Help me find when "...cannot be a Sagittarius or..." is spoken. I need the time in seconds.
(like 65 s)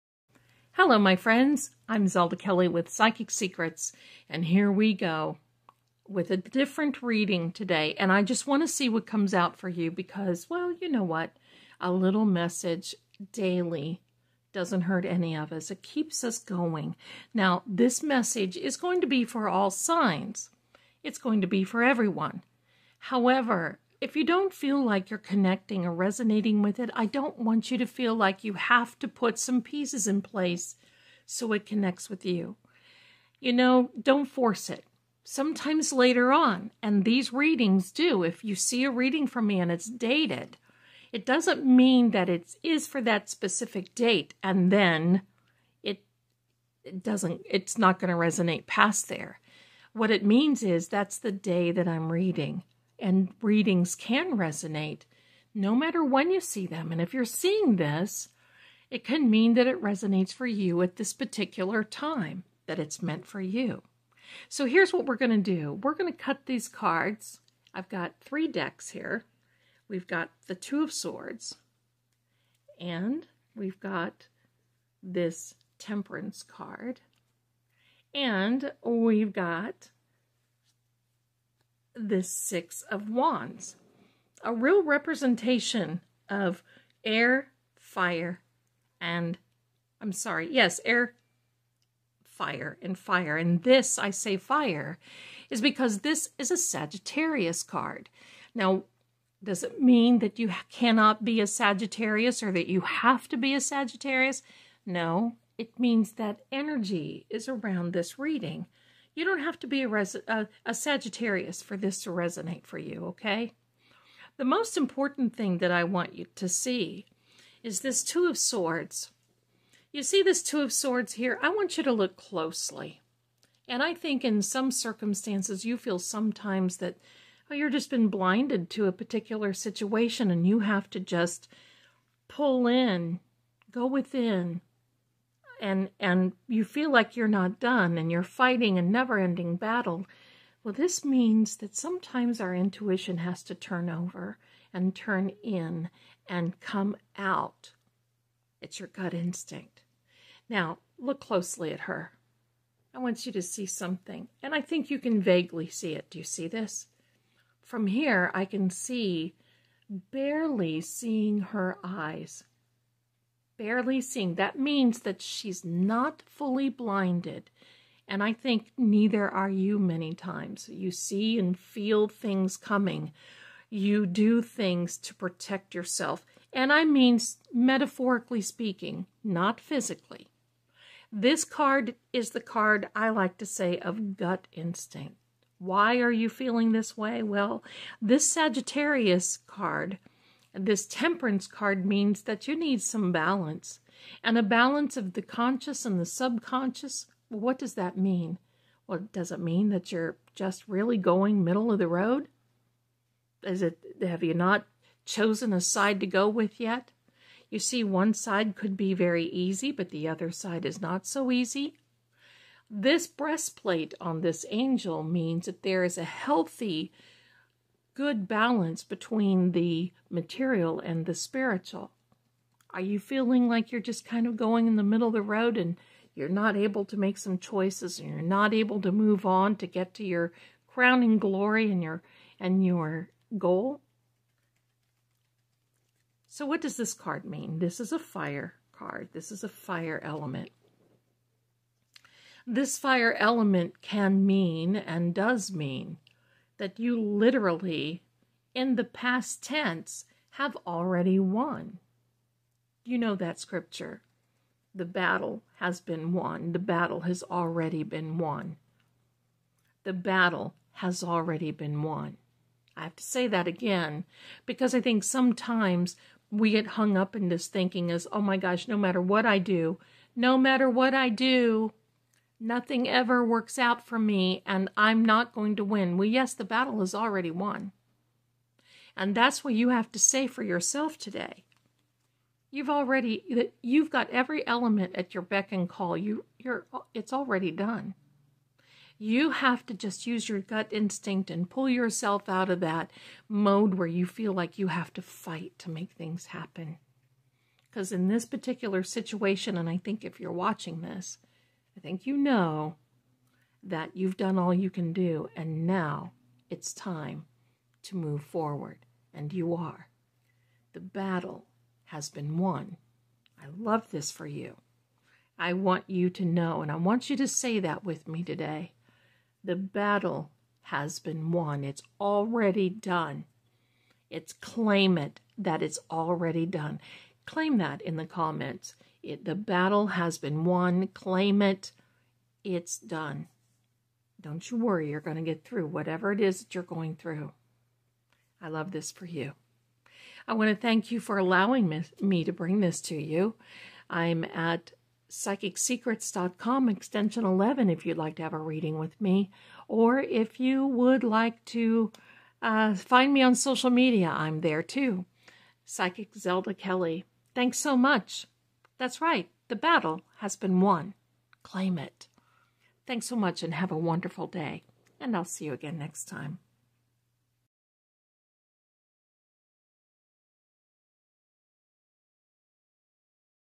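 100 s.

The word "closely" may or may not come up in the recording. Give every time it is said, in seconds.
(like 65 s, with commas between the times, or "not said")
122 s, 151 s.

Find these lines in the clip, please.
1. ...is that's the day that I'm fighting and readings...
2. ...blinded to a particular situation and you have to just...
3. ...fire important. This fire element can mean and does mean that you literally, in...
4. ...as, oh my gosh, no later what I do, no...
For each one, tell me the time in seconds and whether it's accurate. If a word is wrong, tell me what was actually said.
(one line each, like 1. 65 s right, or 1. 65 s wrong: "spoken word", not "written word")
1. 50 s wrong: "reading", not "fighting"
2. 128 s right
3. 239 s wrong: "element", not "important"
4. 267 s wrong: "matter", not "later".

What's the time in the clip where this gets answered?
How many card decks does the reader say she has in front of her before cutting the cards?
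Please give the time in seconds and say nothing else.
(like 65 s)
68 s.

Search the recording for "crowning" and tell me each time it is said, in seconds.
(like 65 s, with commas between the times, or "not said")
230 s.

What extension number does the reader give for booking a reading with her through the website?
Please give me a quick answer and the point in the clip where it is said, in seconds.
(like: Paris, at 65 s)
11, at 346 s.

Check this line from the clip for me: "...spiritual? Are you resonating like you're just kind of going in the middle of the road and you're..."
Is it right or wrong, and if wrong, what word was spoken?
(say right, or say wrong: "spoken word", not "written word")
wrong: "feeling", not "resonating".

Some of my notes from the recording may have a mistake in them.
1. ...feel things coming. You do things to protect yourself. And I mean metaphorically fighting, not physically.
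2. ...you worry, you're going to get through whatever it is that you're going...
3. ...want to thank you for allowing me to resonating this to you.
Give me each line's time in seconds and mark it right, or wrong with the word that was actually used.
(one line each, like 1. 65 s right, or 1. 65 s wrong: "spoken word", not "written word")
1. 171 s wrong: "speaking", not "fighting"
2. 334 s right
3. 340 s wrong: "bring", not "resonating".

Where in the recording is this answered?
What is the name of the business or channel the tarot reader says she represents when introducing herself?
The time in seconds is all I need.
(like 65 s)
2 s.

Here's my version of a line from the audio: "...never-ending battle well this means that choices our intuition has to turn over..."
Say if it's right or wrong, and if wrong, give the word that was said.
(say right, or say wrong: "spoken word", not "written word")
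wrong: "sometimes", not "choices".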